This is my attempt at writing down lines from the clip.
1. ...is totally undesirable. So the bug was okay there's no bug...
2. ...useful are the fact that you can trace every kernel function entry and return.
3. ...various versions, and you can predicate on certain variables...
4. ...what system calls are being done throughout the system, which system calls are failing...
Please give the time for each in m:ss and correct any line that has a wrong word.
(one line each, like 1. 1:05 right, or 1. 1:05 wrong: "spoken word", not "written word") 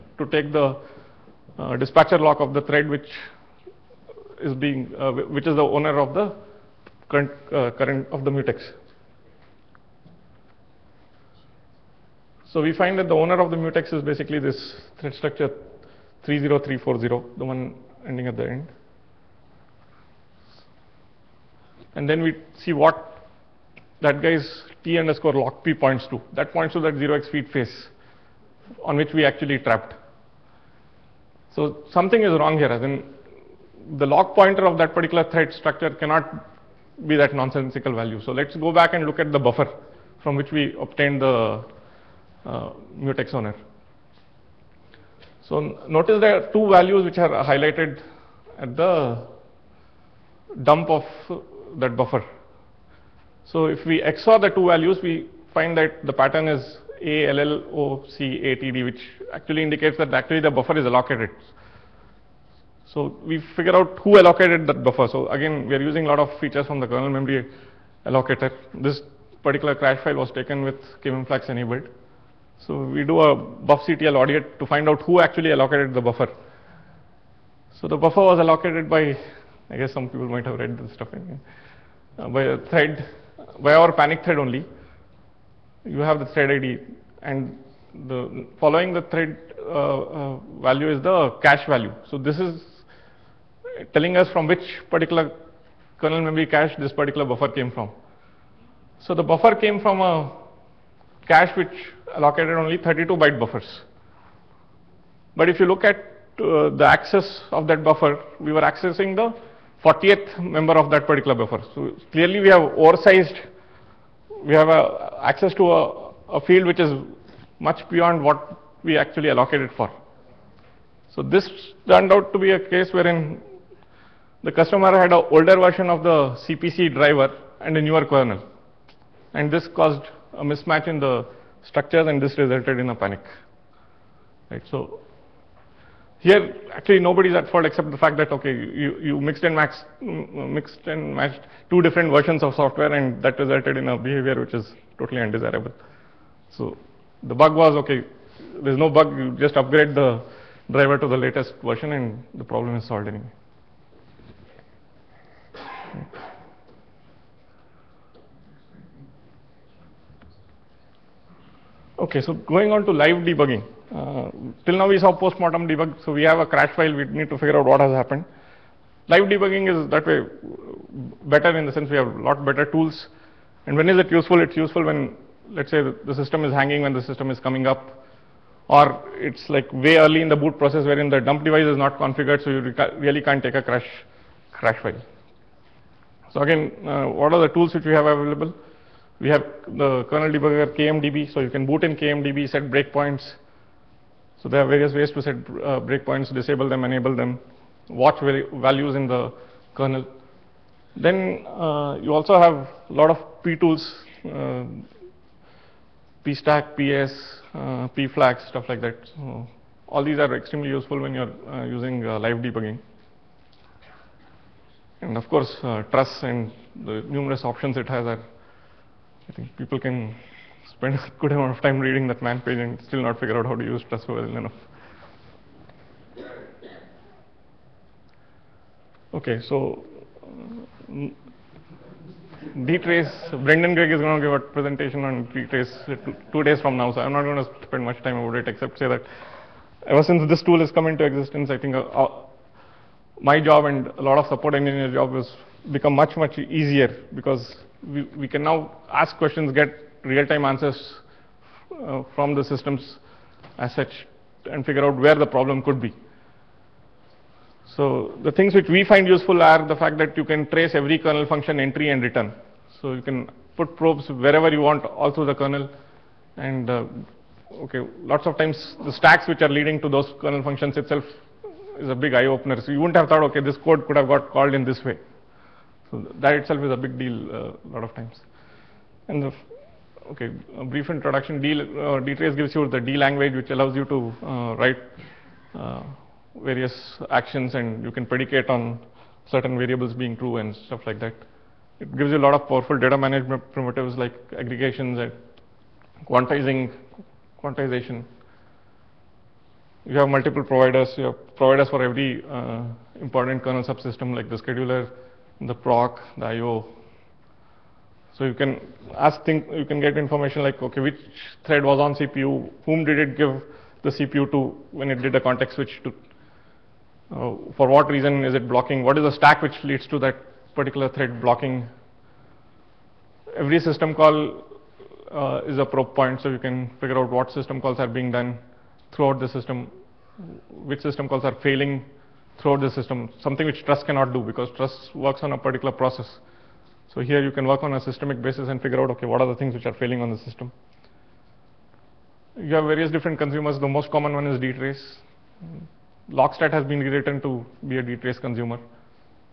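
1. 2:24 right
2. 4:19 right
3. 4:46 wrong: "actions", not "versions"
4. 5:27 right.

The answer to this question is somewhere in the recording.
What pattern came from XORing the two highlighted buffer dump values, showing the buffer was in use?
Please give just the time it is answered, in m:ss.
0:57.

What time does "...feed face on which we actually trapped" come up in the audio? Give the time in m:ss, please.
0:27.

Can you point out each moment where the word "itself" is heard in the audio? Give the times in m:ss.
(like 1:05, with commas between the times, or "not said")
4:30, 4:36.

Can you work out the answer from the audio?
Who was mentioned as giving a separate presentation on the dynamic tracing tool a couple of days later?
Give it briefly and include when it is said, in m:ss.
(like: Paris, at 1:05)
Brendan Gregg, at 3:53.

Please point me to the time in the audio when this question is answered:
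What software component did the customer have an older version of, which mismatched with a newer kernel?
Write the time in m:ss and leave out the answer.
2:06.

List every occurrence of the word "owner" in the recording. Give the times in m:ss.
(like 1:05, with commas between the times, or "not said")
0:05, 0:13.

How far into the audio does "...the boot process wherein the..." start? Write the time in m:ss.
3:00.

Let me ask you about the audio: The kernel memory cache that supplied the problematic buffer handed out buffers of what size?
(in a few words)
32 bytes.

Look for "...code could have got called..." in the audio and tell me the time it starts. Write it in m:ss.
4:33.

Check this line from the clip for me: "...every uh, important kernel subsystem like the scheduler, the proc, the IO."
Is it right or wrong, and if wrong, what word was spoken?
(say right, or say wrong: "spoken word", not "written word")
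right.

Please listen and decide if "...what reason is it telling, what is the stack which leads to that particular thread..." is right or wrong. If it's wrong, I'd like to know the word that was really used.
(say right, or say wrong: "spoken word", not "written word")
wrong: "blocking", not "telling".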